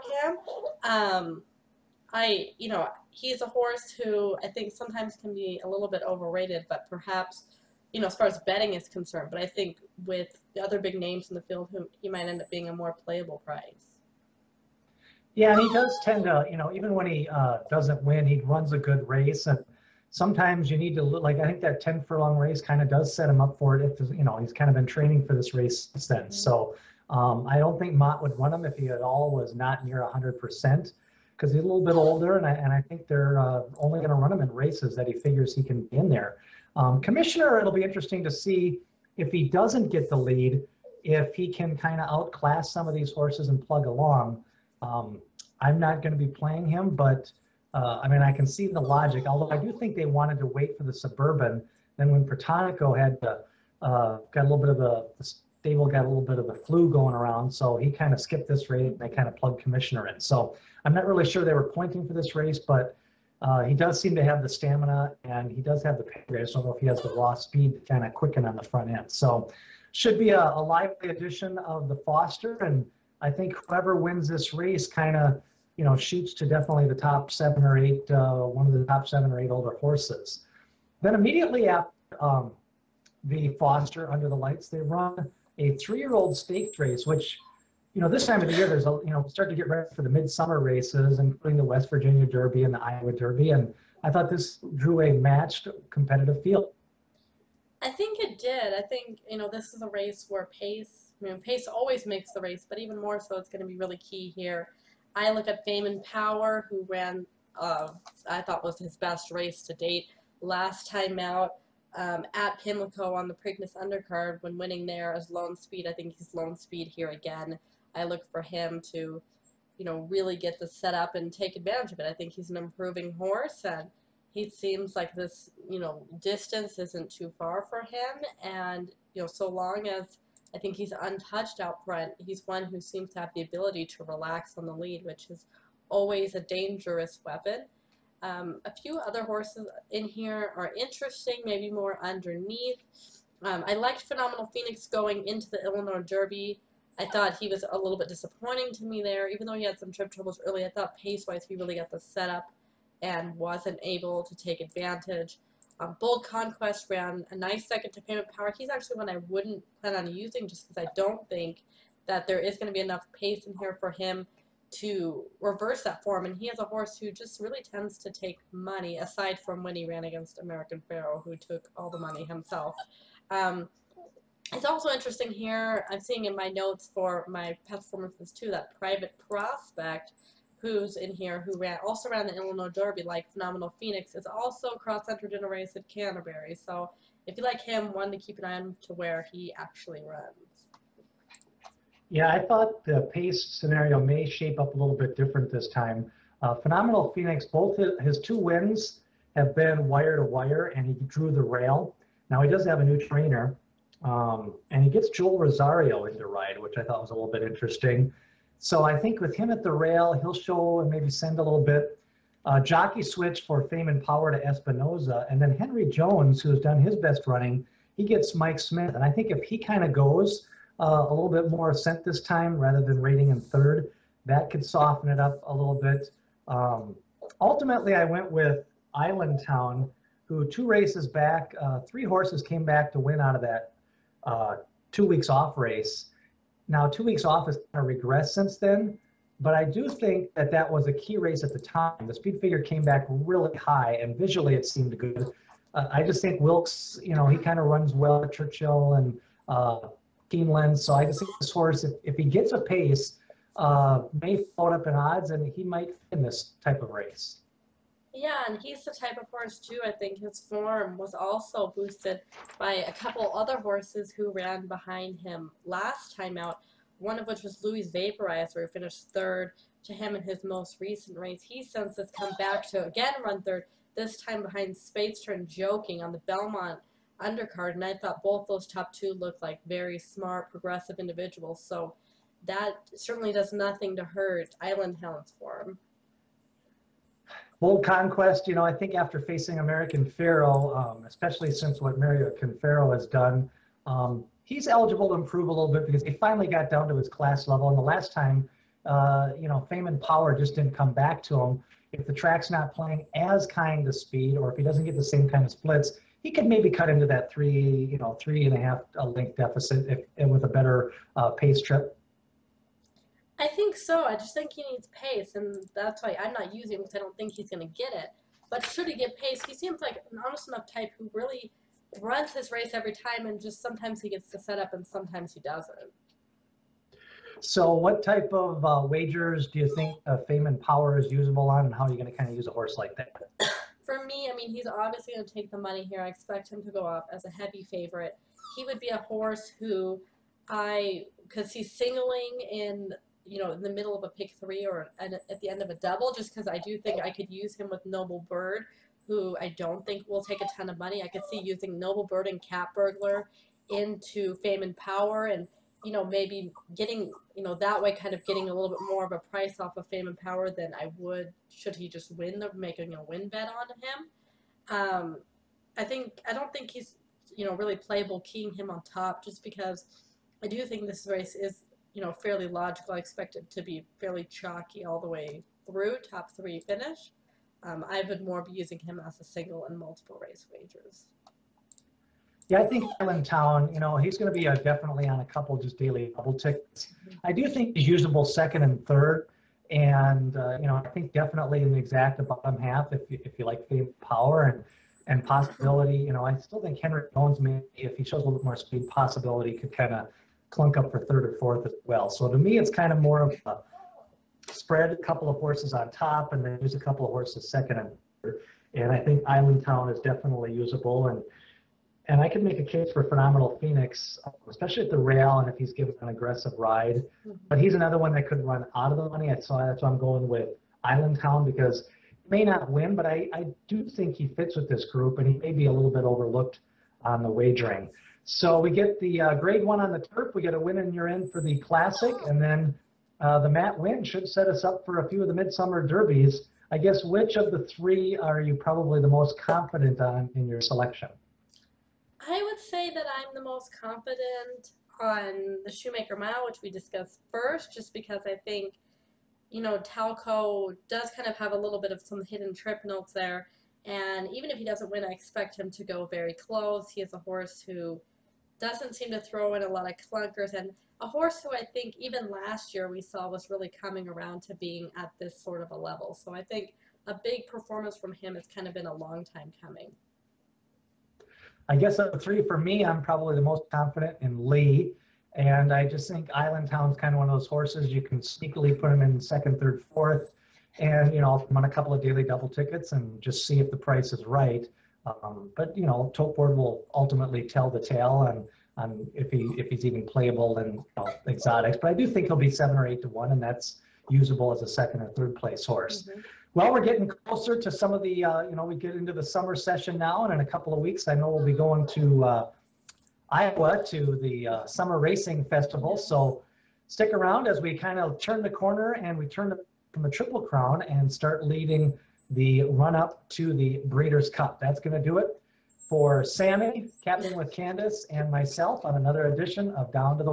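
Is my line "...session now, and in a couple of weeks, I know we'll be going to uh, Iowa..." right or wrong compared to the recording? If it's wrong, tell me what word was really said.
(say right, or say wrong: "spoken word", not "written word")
right.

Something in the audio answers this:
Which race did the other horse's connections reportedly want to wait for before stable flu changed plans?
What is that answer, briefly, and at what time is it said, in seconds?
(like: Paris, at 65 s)
Suburban, at 50 s.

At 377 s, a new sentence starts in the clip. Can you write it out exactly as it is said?
Um, I would more be using him as a single and multiple race wagers.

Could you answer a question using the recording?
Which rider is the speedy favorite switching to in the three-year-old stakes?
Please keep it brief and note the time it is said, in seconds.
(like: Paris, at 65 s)
Espinoza, at 214 s.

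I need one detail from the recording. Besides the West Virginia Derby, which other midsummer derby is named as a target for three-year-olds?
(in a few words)
Iowa Derby.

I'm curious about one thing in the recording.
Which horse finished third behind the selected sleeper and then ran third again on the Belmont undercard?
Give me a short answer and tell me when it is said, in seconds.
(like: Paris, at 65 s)
Louis Vaporizer, at 267 s.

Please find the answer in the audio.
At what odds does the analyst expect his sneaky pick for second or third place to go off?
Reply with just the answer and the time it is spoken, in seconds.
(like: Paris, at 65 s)
7 or 8 to 1, at 492 s.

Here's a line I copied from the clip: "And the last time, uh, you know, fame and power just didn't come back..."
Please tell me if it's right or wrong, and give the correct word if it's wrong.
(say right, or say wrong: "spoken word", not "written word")
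right.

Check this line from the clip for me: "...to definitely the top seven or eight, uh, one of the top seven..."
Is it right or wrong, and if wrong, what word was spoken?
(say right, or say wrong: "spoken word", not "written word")
right.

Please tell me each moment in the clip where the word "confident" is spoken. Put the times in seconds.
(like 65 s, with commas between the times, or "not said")
439 s, 443 s, 473 s.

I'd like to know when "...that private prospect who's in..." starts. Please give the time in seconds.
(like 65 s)
178 s.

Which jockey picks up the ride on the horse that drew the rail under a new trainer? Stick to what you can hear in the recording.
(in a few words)
Joel Rosario.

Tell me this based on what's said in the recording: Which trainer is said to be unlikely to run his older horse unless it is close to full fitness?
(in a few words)
Mott.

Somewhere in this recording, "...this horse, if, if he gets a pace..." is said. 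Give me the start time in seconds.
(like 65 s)
251 s.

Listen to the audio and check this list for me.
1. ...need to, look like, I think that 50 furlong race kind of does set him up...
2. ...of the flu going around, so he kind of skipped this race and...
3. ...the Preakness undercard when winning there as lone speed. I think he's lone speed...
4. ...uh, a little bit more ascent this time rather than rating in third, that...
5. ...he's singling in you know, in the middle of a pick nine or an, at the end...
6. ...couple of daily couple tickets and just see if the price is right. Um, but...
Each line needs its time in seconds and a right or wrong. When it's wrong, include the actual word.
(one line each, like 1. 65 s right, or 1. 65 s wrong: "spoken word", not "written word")
1. 20 s wrong: "10", not "50"
2. 56 s right
3. 113 s right
4. 220 s right
5. 341 s wrong: "three", not "nine"
6. 481 s wrong: "double", not "couple".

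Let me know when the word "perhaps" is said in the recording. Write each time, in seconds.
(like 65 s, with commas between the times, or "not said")
6 s.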